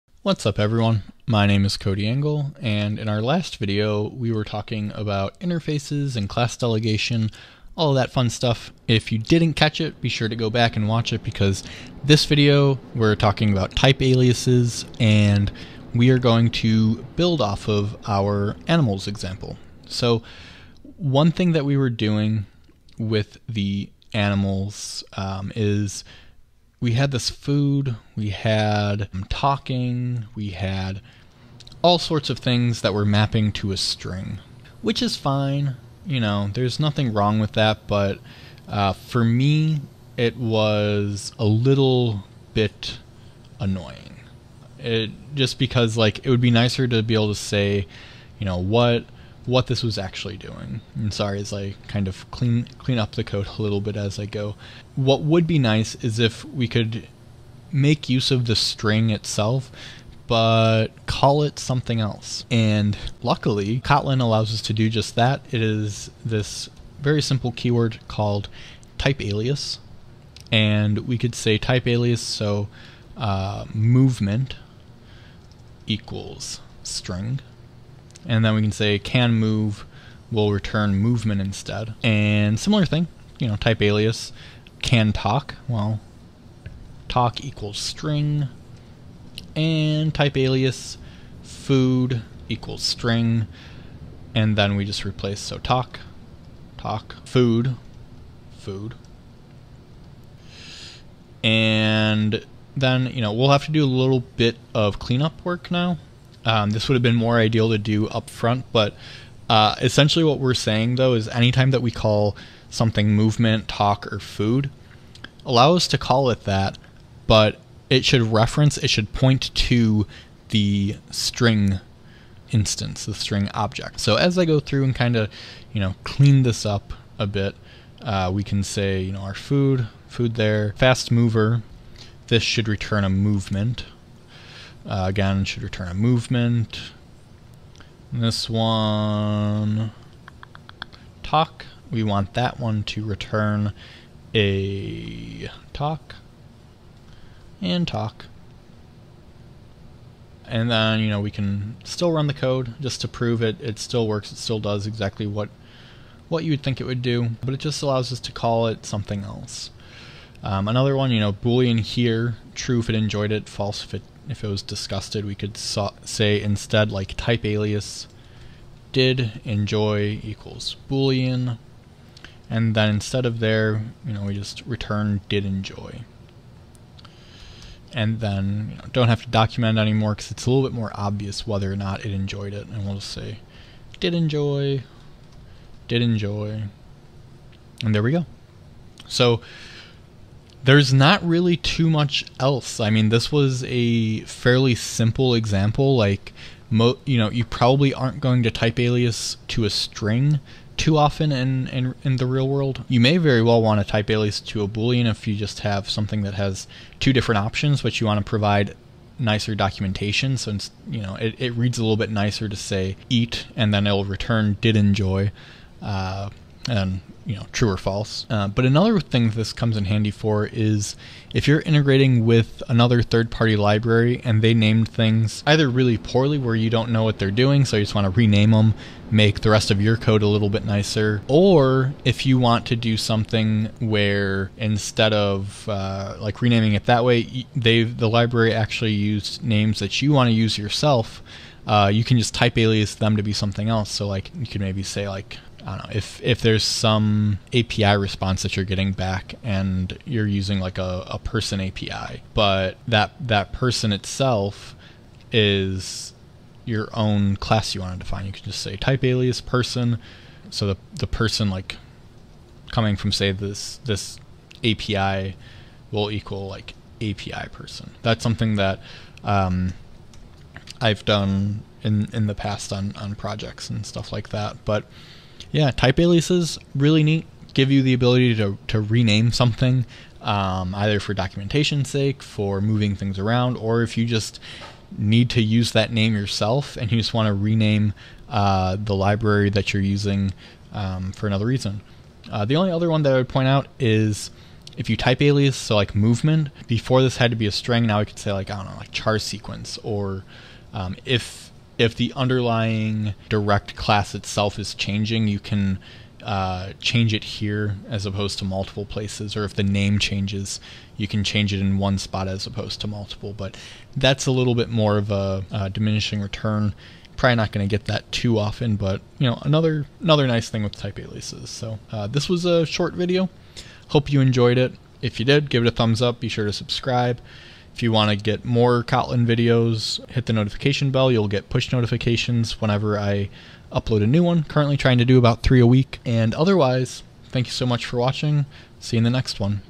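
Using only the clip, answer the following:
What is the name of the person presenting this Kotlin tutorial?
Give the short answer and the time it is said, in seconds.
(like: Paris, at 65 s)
Cody Engel, at 1 s.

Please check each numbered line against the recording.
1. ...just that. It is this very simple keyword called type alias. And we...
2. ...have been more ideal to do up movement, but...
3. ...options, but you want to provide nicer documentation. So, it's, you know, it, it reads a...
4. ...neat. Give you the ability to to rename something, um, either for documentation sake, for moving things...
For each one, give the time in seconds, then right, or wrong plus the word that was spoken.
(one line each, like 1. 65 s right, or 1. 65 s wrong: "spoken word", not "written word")
1. 64 s right
2. 106 s wrong: "front", not "movement"
3. 207 s right
4. 277 s right.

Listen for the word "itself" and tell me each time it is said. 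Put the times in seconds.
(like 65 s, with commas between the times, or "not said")
59 s, 253 s, 304 s.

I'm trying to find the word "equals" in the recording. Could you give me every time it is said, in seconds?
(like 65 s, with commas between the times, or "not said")
75 s, 87 s, 92 s, 170 s, 266 s.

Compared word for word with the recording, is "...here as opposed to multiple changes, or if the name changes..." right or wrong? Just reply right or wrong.
wrong.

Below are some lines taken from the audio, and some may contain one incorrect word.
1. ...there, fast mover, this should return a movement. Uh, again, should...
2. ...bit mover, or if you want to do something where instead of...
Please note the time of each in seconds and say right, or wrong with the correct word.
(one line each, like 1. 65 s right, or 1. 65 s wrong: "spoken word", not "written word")
1. 130 s right
2. 230 s wrong: "nicer", not "mover".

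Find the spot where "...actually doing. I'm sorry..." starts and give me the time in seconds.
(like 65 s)
49 s.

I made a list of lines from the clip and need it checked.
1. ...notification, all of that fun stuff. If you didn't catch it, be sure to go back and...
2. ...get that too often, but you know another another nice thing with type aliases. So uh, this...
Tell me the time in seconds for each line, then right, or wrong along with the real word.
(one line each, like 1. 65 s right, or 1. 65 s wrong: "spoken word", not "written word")
1. 6 s wrong: "delegation", not "notification"
2. 317 s right.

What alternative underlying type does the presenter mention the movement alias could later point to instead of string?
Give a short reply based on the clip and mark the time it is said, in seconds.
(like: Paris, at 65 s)
char sequence, at 298 s.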